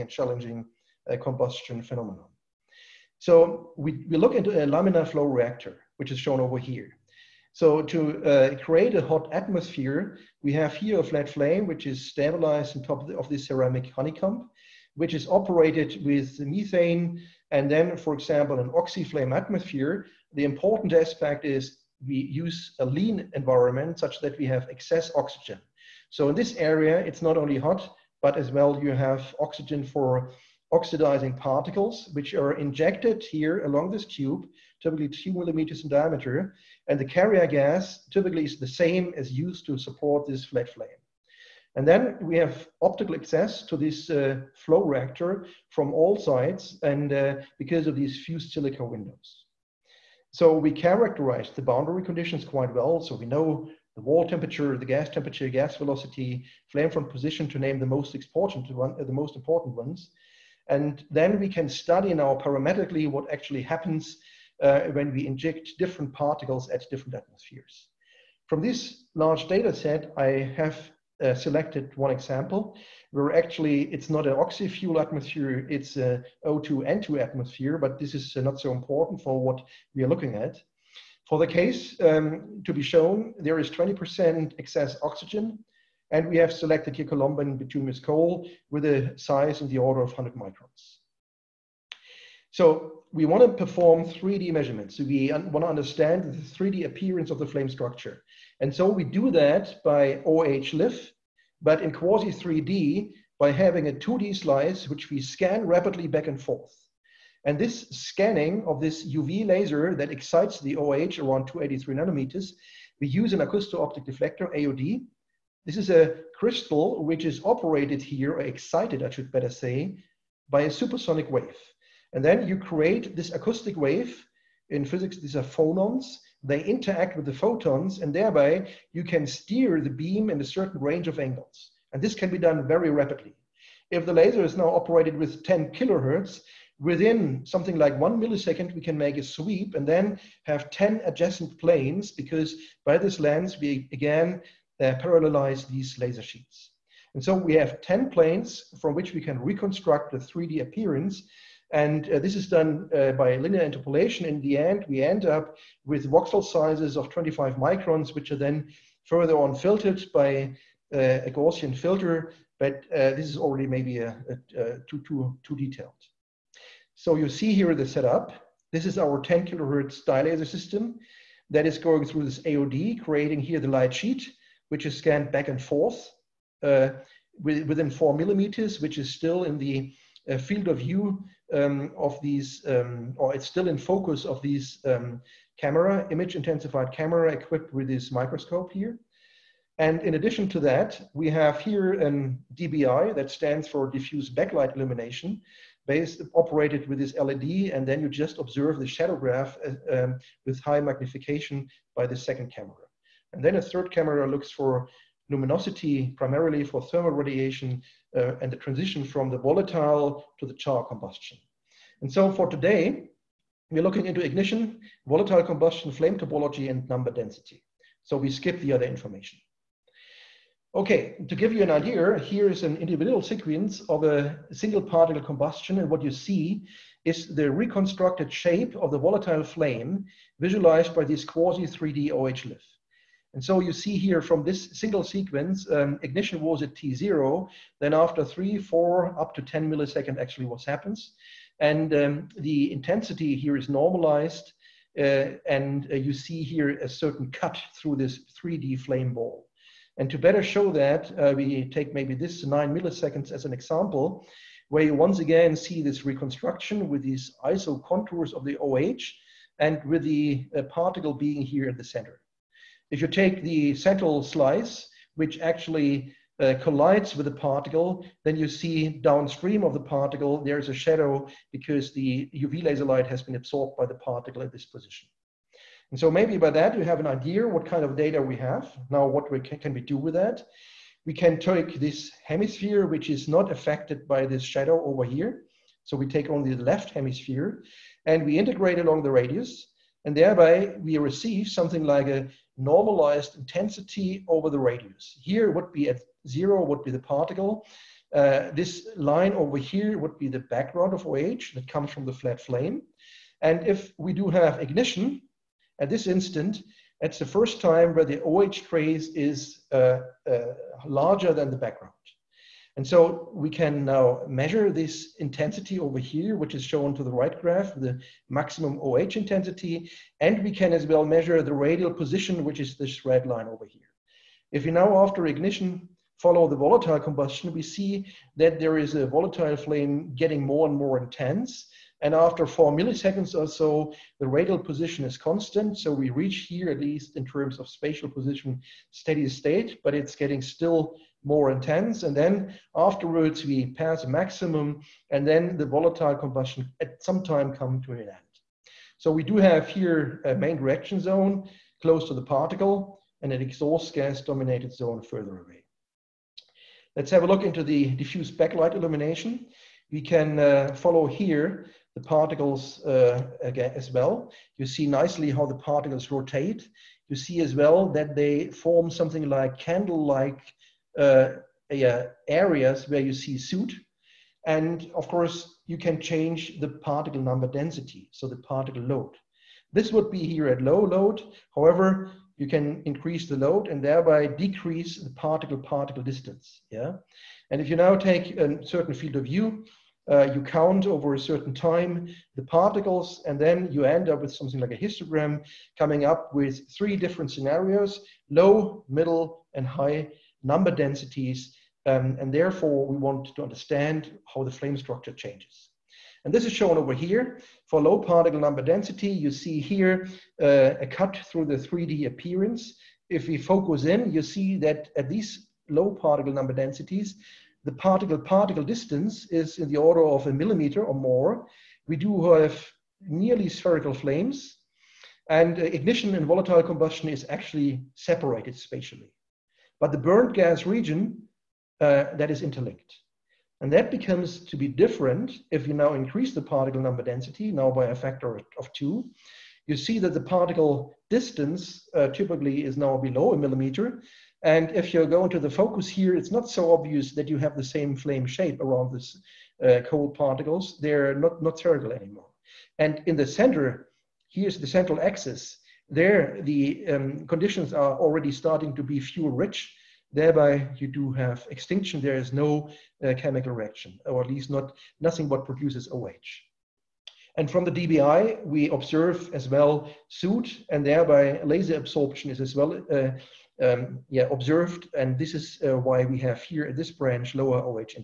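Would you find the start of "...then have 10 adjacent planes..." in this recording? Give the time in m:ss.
2:19.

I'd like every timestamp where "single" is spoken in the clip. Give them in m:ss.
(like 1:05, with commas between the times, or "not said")
3:44, 3:54.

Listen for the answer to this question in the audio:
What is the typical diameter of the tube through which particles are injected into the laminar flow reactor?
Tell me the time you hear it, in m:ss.
0:35.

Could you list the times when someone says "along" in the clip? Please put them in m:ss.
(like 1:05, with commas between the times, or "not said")
0:33, 4:48.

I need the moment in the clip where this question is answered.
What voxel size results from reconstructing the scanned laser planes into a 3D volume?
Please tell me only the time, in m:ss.
2:37.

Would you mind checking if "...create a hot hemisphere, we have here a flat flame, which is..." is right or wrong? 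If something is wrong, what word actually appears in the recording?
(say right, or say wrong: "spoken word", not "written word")
wrong: "atmosphere", not "hemisphere".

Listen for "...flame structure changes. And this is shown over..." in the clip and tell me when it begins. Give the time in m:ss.
6:44.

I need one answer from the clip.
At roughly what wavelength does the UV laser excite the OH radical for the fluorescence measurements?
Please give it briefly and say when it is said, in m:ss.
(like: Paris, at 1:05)
283 nanometers, at 1:51.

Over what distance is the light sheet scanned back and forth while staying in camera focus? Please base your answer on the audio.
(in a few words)
4 mm.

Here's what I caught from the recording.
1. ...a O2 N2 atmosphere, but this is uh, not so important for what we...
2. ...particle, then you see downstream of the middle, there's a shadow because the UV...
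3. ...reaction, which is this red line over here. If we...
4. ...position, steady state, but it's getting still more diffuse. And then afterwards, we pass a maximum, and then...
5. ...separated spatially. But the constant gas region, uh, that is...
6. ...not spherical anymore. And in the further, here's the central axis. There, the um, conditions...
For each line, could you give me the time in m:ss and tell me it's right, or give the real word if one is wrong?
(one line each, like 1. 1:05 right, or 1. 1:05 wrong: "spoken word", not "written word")
1. 1:15 right
2. 4:27 wrong: "particle", not "middle"
3. 5:21 wrong: "position", not "reaction"
4. 5:38 wrong: "intense", not "diffuse"
5. 7:07 wrong: "burnt", not "constant"
6. 7:31 wrong: "center", not "further".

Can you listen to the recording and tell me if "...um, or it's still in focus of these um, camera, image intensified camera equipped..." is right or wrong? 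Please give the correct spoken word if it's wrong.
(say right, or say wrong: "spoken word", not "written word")
right.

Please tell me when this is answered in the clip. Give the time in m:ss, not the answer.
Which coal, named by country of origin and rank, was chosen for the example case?
1:27.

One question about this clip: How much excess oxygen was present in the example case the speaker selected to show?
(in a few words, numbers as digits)
20%.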